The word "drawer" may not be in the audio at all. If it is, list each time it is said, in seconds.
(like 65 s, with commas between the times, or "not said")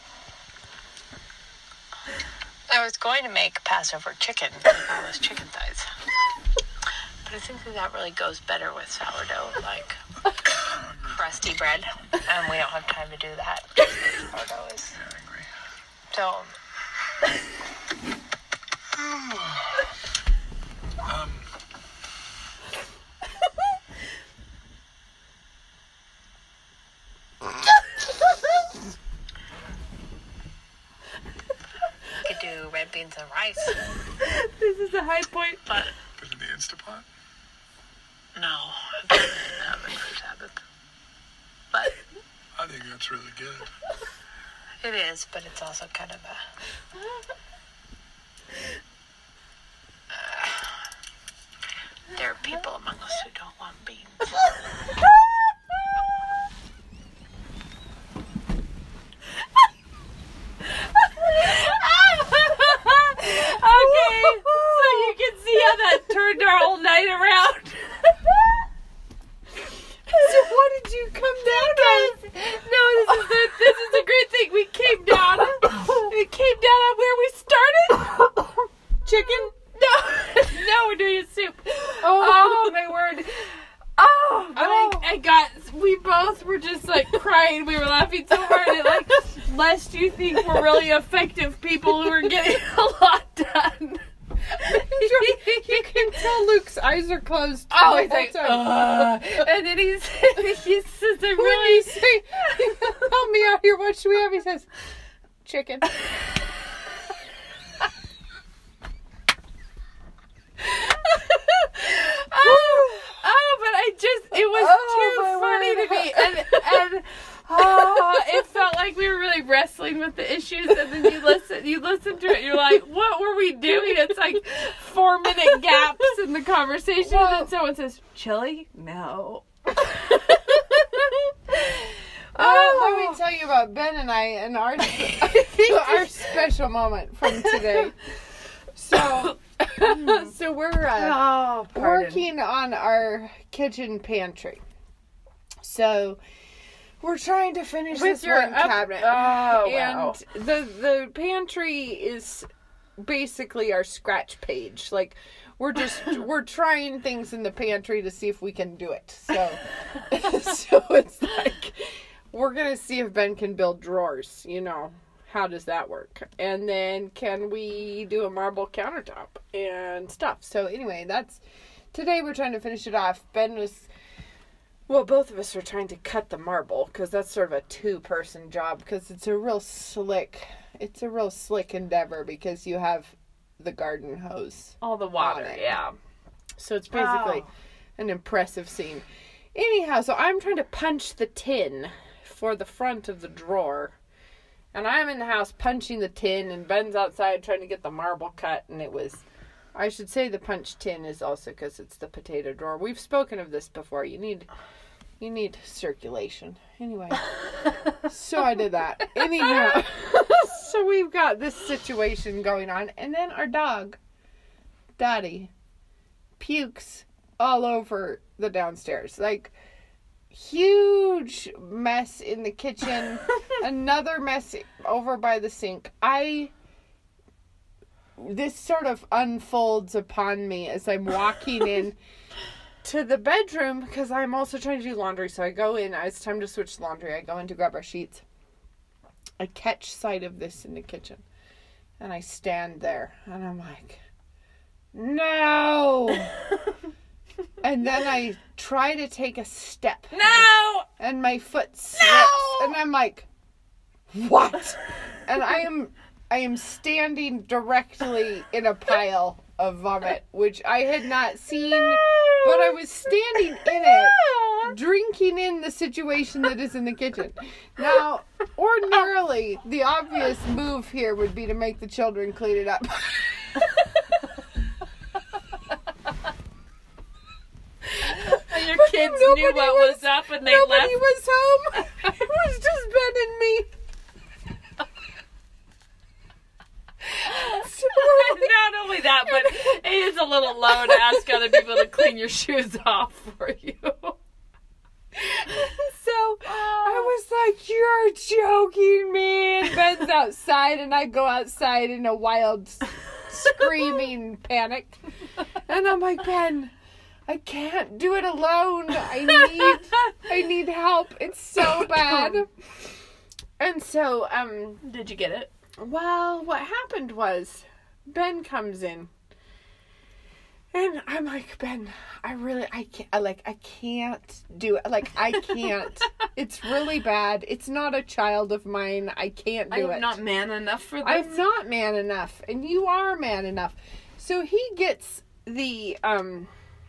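163 s, 193 s, 202 s.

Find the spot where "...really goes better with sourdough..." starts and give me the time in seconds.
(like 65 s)
7 s.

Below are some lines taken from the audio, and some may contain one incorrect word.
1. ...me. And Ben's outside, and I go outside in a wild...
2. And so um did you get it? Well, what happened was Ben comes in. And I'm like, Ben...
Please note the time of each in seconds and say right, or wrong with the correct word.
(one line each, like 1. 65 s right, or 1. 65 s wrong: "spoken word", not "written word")
1. 299 s right
2. 313 s right.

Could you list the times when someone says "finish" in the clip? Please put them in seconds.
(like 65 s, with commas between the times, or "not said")
147 s, 172 s.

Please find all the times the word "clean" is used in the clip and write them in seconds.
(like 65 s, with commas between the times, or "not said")
272 s, 291 s.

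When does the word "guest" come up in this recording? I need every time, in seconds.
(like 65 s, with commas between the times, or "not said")
not said.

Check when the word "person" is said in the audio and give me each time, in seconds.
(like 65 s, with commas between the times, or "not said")
177 s.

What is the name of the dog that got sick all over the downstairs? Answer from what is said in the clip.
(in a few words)
Daddy.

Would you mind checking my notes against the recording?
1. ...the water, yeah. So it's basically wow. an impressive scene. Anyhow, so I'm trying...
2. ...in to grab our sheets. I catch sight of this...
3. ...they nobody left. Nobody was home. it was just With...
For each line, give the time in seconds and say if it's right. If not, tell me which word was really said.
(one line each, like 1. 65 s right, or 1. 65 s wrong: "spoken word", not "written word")
1. 184 s right
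2. 237 s right
3. 280 s wrong: "Ben", not "With".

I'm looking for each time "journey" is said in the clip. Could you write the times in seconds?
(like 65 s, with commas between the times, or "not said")
not said.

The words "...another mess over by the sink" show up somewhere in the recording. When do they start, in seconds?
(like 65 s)
223 s.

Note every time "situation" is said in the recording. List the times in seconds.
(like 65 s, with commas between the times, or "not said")
211 s, 265 s.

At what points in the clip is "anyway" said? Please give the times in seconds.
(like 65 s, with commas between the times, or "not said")
170 s, 206 s.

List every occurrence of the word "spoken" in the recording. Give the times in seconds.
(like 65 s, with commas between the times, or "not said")
202 s.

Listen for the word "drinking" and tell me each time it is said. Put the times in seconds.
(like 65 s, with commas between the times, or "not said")
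264 s.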